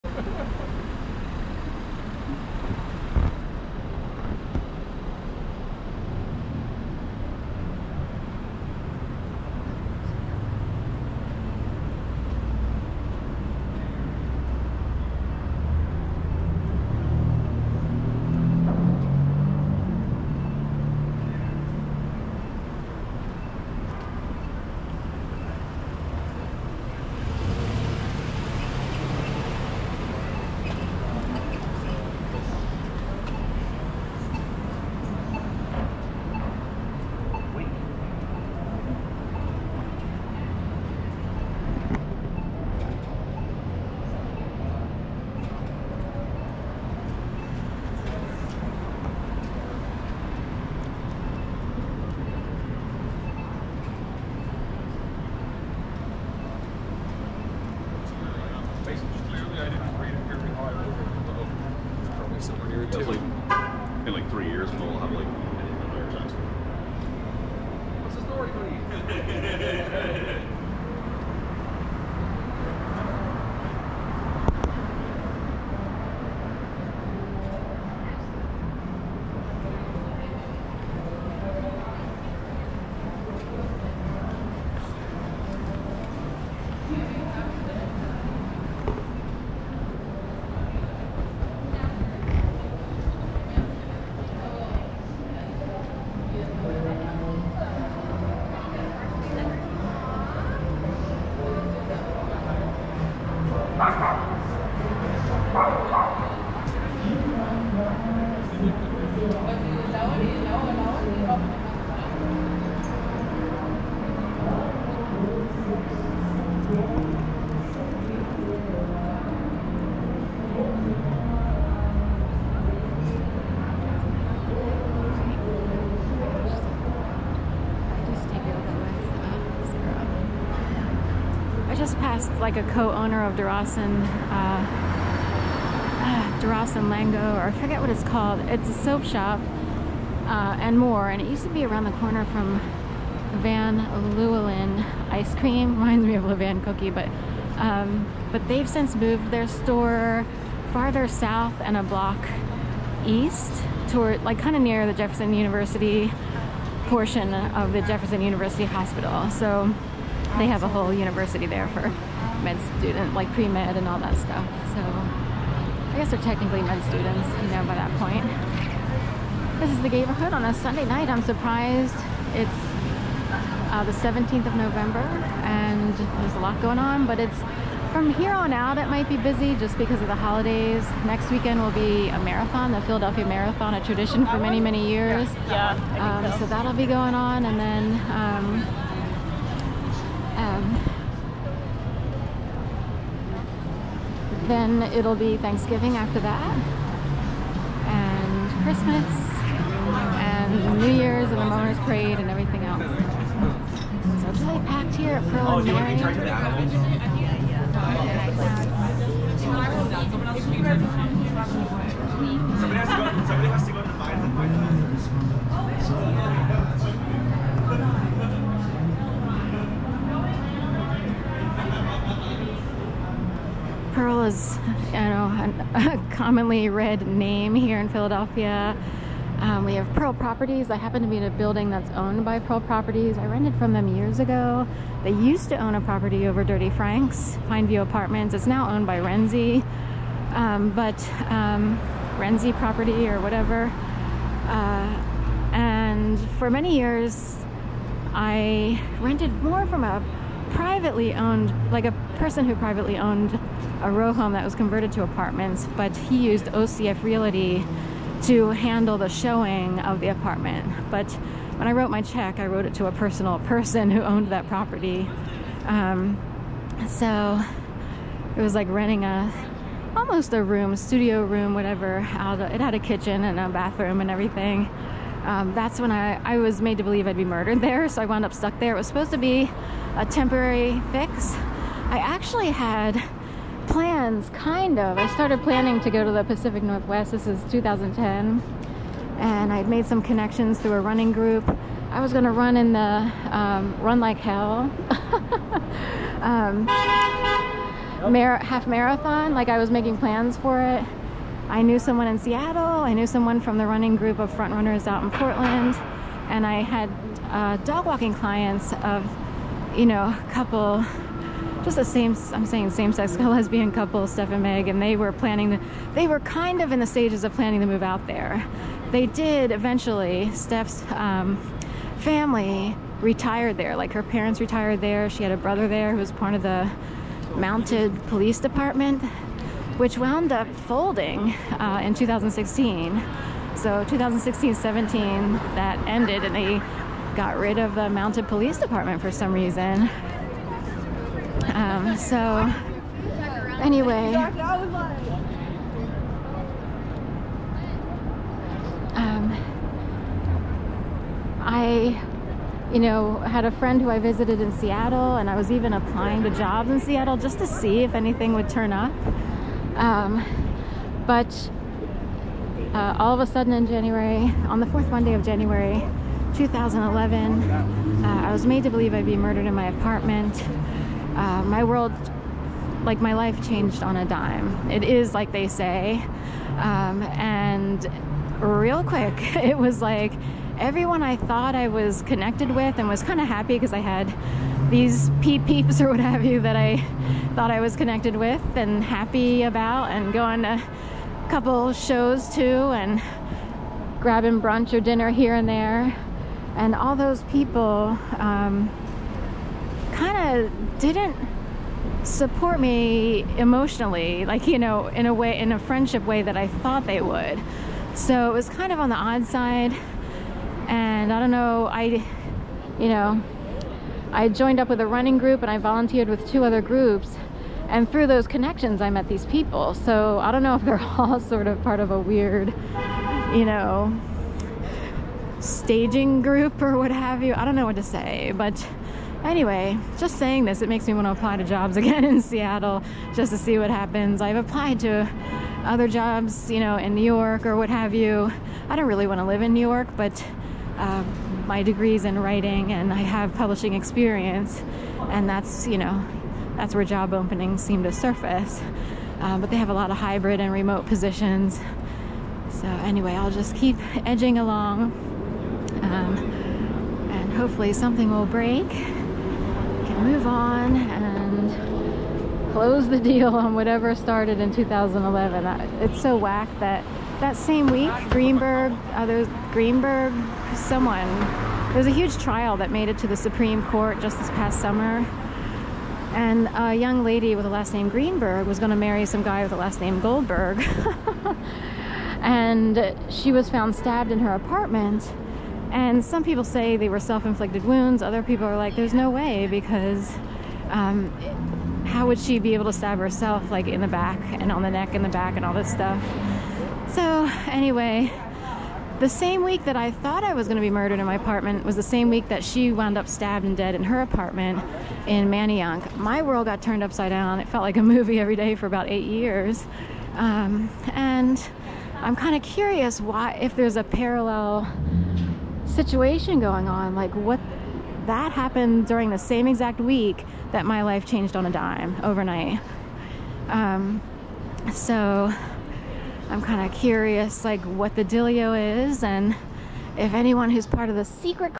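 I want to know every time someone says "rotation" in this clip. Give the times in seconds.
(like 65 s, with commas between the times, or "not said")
not said.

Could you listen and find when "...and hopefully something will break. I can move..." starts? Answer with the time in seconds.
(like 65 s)
457 s.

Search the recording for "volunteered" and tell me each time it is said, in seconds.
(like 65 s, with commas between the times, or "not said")
415 s.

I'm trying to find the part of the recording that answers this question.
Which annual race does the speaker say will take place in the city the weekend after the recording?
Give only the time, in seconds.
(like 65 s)
182 s.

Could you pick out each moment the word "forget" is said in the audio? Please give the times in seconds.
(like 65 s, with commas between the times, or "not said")
137 s.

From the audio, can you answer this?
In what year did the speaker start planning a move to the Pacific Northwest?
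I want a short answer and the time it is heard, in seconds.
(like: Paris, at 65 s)
2010, at 287 s.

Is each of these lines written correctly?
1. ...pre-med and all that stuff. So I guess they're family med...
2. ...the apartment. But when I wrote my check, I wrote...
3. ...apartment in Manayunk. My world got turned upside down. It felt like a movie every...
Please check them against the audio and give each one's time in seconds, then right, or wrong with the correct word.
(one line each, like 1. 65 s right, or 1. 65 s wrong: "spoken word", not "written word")
1. 163 s wrong: "technically", not "family"
2. 259 s right
3. 504 s right.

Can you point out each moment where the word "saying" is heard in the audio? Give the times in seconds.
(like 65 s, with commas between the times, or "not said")
312 s, 430 s.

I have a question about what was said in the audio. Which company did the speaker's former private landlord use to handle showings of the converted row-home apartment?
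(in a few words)
OCF Realty.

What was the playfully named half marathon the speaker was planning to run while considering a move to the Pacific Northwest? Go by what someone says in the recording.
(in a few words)
Run Like Hell.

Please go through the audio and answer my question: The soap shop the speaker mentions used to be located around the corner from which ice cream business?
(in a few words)
Van Leeuwen.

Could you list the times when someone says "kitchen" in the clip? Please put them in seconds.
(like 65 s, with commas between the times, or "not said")
272 s.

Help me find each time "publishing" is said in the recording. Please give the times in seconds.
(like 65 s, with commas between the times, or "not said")
443 s.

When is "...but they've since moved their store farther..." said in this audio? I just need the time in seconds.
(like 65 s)
148 s.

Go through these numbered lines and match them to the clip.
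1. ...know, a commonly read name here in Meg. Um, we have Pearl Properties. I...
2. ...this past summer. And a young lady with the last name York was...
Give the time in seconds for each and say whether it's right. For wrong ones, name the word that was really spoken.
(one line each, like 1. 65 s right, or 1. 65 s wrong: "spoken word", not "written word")
1. 224 s wrong: "Philadelphia", not "Meg"
2. 474 s wrong: "Greenberg", not "York".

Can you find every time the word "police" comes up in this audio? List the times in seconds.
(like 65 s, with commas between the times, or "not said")
328 s, 338 s.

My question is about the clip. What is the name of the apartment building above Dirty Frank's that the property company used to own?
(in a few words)
Pineview Apartments.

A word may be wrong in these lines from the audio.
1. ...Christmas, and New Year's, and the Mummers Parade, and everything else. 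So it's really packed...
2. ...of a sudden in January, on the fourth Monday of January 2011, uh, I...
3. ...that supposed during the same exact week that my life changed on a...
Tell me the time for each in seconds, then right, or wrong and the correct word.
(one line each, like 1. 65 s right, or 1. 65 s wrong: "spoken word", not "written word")
1. 198 s right
2. 363 s right
3. 518 s wrong: "happened", not "supposed".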